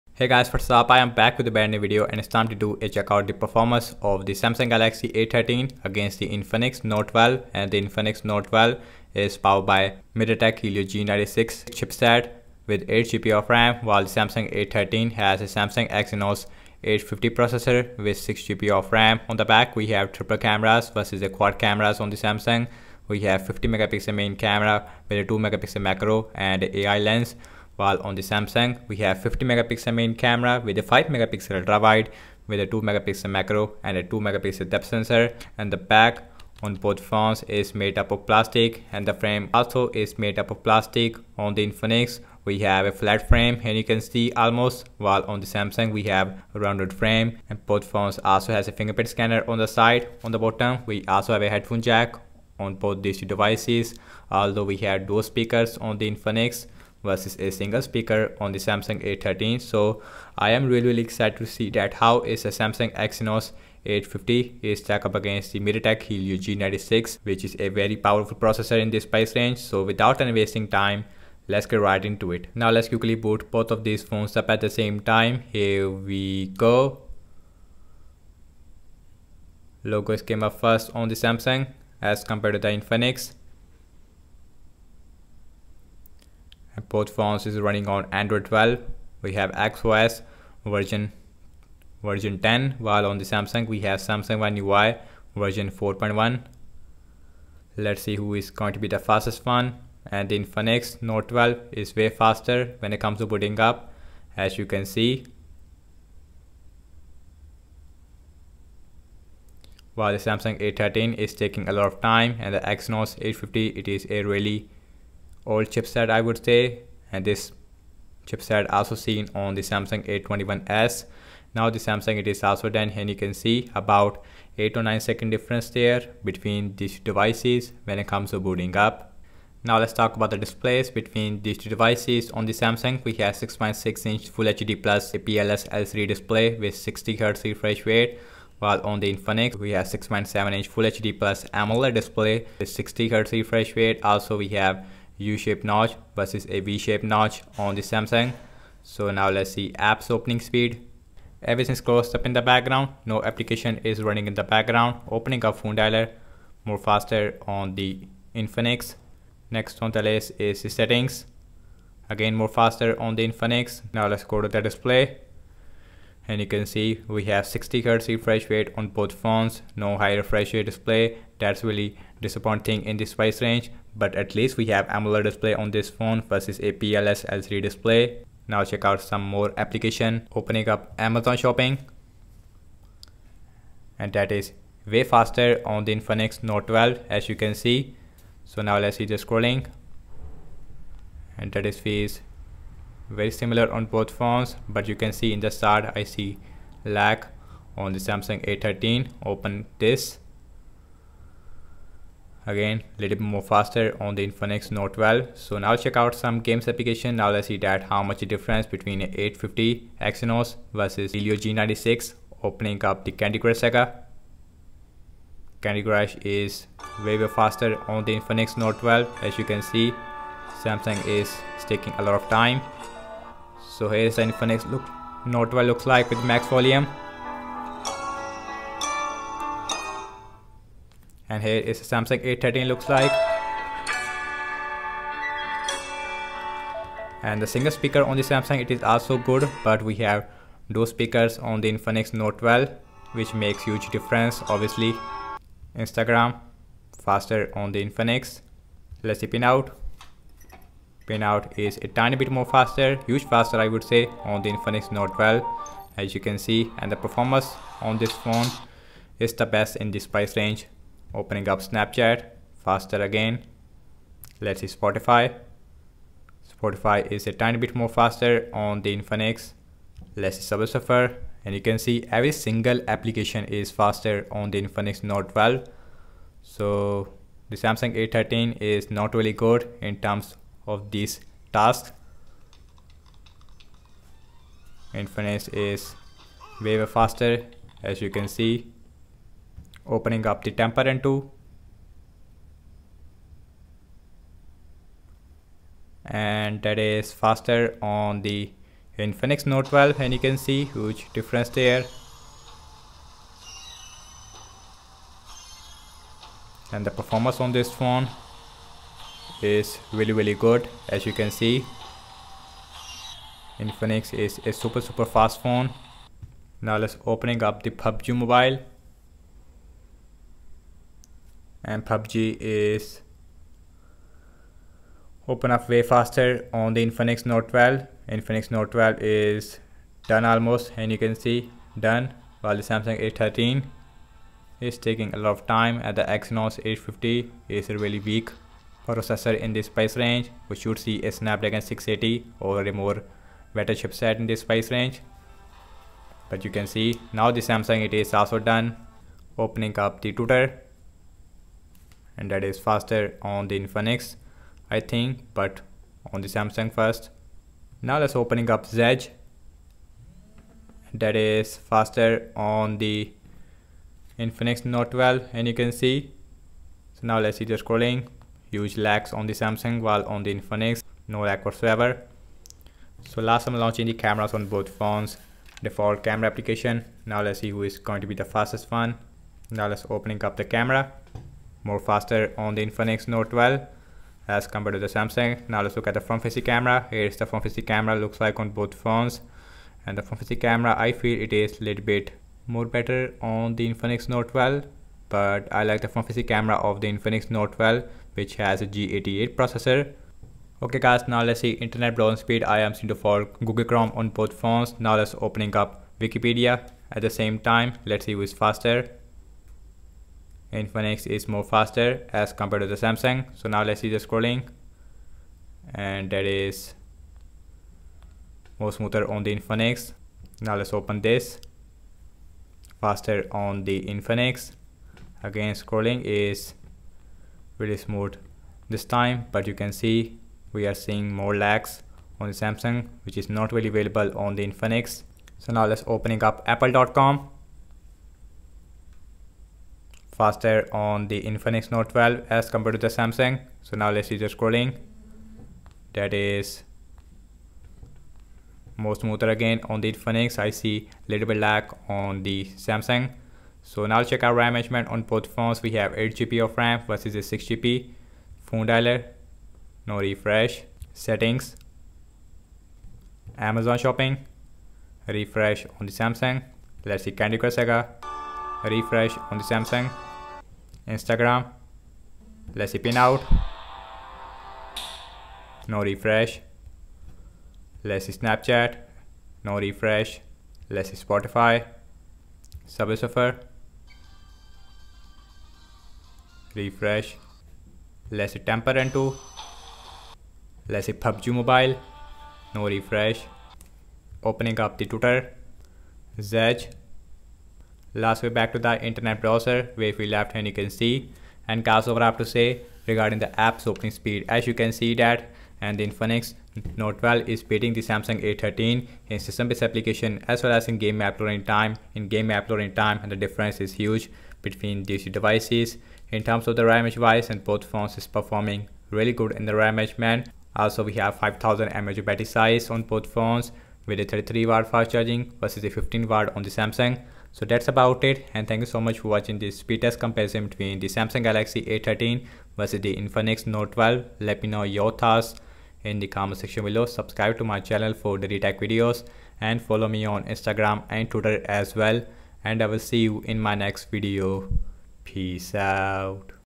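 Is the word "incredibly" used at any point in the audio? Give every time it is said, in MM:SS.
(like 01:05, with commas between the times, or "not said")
not said.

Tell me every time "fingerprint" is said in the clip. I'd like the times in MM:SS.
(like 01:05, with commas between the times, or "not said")
00:48.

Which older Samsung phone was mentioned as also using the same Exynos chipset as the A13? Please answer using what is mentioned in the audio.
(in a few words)
Samsung A21s.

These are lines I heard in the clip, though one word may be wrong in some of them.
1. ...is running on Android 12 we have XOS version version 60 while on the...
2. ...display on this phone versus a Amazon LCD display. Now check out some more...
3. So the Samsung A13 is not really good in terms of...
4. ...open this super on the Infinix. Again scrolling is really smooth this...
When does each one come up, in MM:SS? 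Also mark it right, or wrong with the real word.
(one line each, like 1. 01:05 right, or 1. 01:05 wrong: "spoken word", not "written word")
1. 01:27 wrong: "10", not "60"
2. 02:55 wrong: "PLS", not "Amazon"
3. 04:36 right
4. 07:00 wrong: "faster", not "super".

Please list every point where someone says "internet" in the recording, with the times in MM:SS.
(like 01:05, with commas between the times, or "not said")
06:41, 08:18.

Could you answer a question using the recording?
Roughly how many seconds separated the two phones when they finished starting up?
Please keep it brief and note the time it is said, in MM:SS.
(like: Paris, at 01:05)
8 or 9 seconds, at 02:04.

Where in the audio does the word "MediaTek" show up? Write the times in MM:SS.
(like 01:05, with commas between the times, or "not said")
00:10, 01:05.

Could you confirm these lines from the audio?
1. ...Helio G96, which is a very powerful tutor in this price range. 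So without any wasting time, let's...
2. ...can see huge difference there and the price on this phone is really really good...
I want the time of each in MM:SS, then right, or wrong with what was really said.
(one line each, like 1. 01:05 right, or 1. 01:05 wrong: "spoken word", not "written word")
1. 01:06 wrong: "processor", not "tutor"
2. 05:00 wrong: "performance", not "price".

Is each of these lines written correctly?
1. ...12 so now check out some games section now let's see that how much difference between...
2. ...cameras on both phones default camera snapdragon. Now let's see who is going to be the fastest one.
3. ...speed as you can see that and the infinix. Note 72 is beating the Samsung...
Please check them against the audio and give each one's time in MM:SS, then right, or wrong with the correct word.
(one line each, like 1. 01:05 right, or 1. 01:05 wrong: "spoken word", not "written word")
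1. 03:24 wrong: "application", not "section"
2. 06:13 wrong: "application", not "snapdragon"
3. 08:23 wrong: "12", not "72".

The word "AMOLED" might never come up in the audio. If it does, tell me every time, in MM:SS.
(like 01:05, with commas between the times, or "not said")
02:21, 02:54.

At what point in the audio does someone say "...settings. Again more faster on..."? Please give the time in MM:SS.
02:40.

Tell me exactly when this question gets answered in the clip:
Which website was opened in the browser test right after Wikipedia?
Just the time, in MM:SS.
07:16.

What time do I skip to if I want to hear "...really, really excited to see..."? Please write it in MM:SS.
01:00.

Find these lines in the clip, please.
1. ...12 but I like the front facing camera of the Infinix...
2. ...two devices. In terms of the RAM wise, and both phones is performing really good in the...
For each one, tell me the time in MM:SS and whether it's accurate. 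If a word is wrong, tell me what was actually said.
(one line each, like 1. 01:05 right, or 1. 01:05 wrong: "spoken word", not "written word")
1. 06:34 right
2. 08:35 right.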